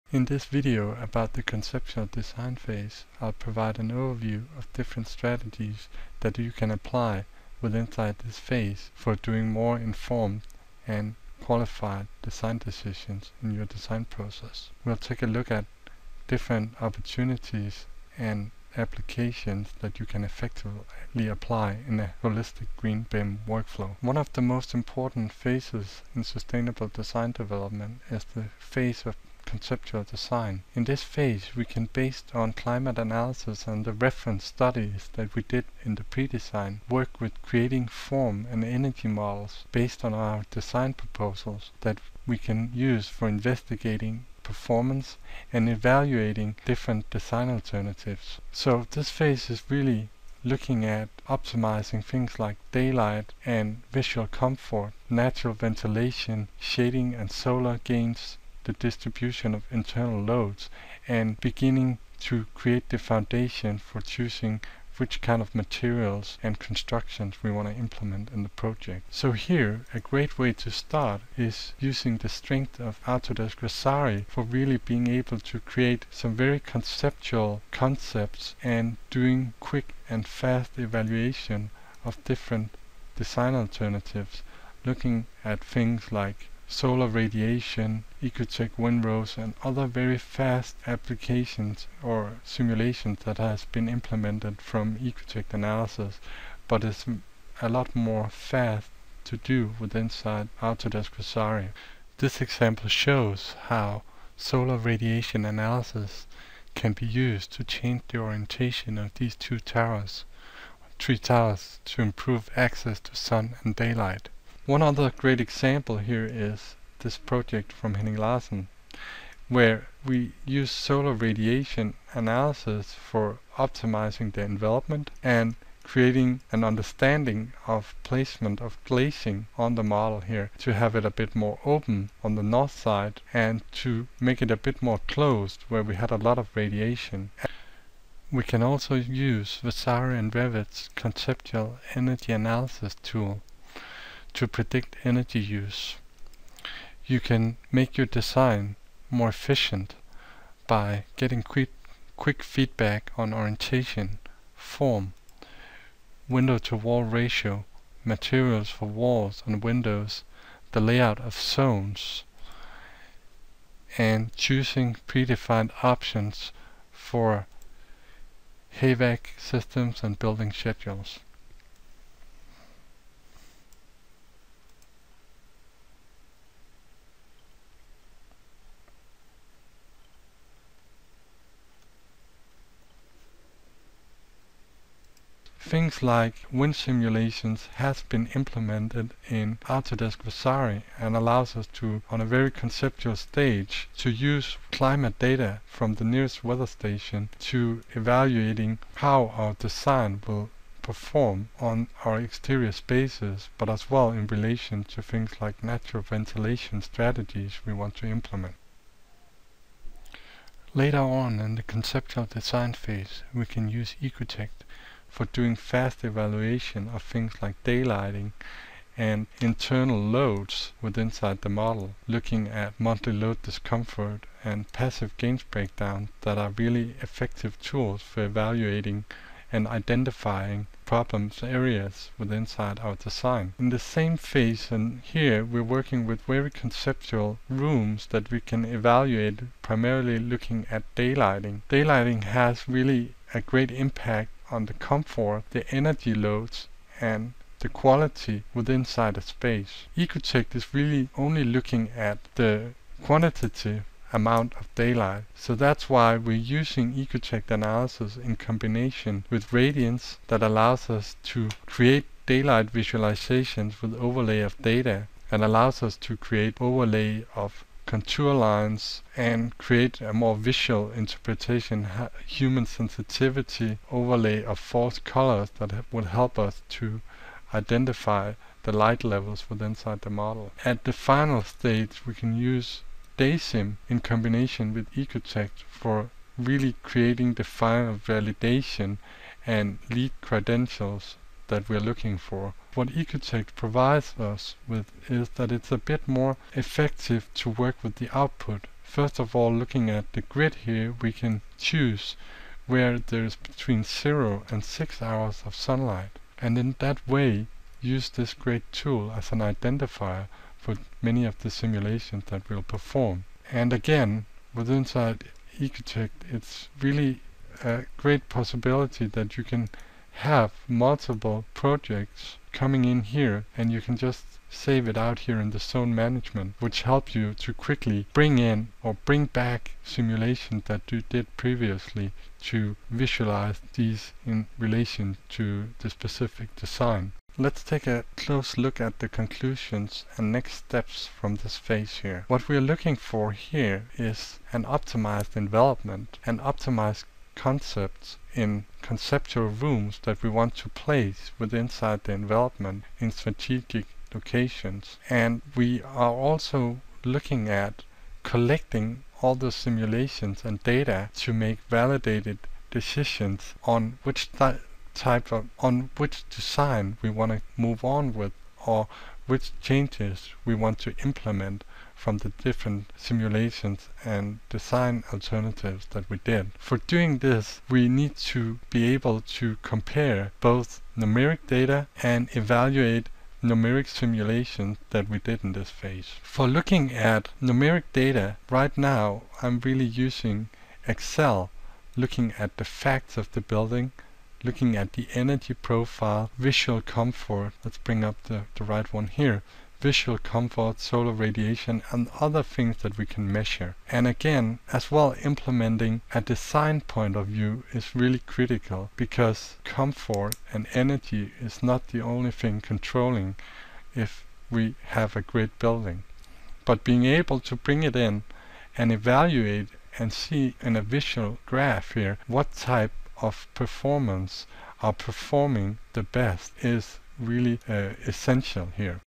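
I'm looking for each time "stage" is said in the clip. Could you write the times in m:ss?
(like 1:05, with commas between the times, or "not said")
3:13, 4:41.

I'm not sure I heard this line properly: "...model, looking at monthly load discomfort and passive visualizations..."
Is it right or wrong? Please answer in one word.
wrong.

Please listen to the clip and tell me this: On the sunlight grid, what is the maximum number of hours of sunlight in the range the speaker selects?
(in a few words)
6.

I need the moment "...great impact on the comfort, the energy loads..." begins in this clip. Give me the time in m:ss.
4:03.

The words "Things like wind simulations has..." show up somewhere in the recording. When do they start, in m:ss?
3:05.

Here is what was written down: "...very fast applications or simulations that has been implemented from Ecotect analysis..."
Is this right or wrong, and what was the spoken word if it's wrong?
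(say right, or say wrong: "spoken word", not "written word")
right.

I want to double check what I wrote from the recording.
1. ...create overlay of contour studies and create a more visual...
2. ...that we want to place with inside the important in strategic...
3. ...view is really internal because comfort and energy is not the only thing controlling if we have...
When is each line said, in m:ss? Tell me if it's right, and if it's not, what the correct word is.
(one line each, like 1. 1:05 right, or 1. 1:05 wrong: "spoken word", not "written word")
1. 4:26 wrong: "lines", not "studies"
2. 5:50 wrong: "envelopment", not "important"
3. 6:47 wrong: "critical", not "internal".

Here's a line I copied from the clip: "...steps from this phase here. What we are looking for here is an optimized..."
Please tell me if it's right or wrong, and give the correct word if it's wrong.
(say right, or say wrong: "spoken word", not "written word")
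right.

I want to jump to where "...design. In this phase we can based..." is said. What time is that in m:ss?
0:30.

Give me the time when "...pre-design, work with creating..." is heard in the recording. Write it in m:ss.
0:36.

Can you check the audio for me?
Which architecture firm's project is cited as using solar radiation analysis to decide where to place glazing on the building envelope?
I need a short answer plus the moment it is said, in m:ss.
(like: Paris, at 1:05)
Henning Larsen, at 1:57.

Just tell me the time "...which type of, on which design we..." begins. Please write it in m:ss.
6:04.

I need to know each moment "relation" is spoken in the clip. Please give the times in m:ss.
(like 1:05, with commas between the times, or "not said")
3:24, 5:34.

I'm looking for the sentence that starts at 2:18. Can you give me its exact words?
We can also use Vasari and Revit's conceptual energy analysis tool to predict energy use.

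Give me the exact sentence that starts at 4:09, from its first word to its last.
Ecotect is really only looking at the quantitative amount of daylight.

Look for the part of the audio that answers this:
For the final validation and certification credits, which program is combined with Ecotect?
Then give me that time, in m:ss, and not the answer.
4:43.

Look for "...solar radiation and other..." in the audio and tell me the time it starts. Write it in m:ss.
6:40.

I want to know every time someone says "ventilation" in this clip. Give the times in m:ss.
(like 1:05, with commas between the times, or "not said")
0:55, 3:26.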